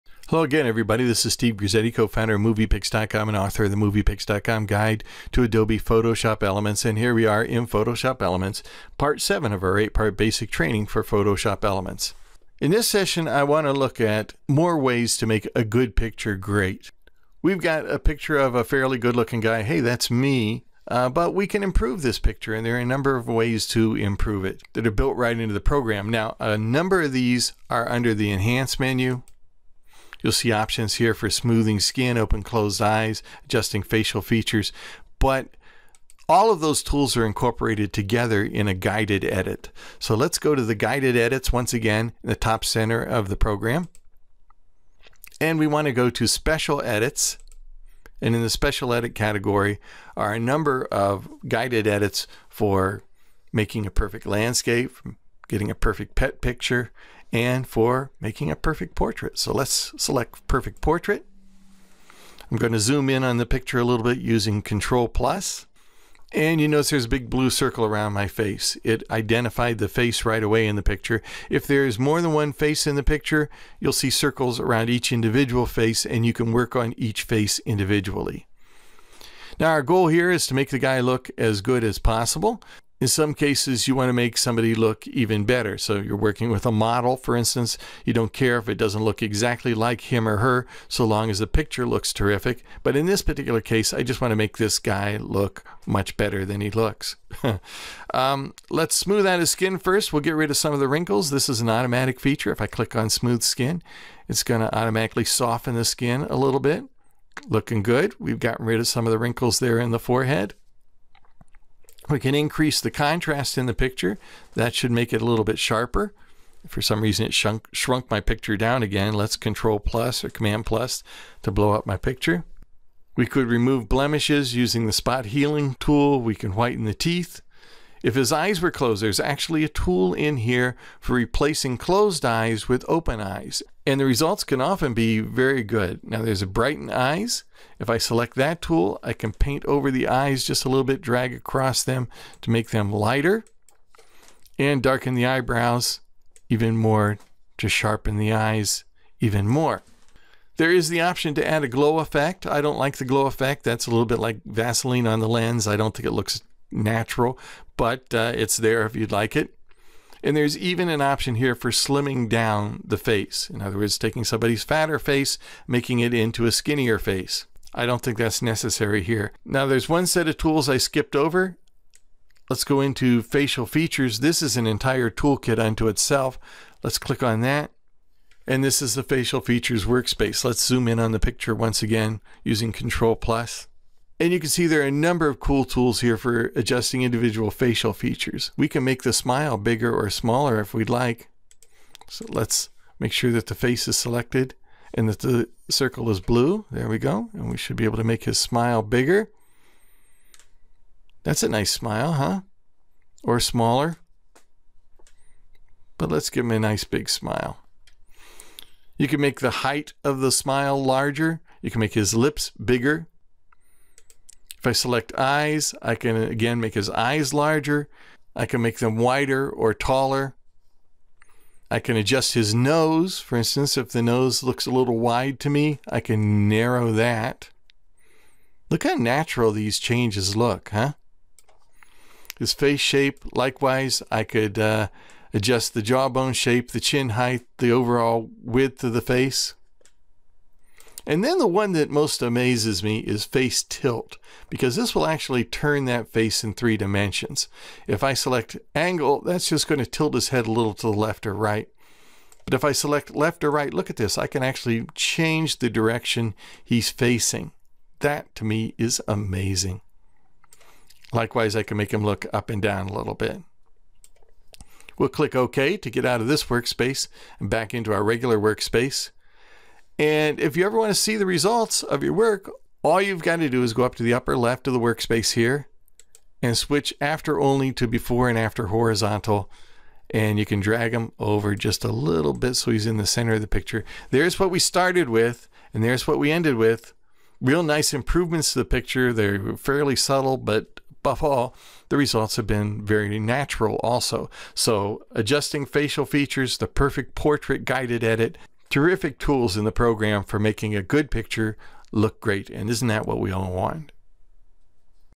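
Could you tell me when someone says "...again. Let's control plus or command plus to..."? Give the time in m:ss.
1:58.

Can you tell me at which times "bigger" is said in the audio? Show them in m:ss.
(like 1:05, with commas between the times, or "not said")
3:09, 3:18, 3:32.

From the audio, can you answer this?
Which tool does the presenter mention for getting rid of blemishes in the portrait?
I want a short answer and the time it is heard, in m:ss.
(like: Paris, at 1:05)
Spot healing tool, at 2:04.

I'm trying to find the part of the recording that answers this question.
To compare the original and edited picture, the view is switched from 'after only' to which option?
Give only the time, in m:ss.
4:37.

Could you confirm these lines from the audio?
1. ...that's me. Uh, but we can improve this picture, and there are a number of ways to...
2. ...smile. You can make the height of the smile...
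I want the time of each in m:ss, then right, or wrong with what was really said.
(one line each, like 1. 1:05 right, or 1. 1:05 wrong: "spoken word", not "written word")
1. 0:19 right
2. 3:27 right.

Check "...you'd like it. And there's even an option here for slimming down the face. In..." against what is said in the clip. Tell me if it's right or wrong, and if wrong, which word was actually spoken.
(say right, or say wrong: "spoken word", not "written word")
right.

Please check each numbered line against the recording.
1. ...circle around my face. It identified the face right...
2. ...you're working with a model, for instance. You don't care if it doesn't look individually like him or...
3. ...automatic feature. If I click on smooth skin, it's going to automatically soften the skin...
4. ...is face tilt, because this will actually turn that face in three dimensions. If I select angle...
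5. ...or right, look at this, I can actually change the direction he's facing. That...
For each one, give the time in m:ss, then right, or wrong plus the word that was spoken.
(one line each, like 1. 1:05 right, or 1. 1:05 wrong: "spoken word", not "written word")
1. 1:07 right
2. 1:25 wrong: "exactly", not "individually"
3. 1:41 right
4. 4:02 right
5. 4:13 right.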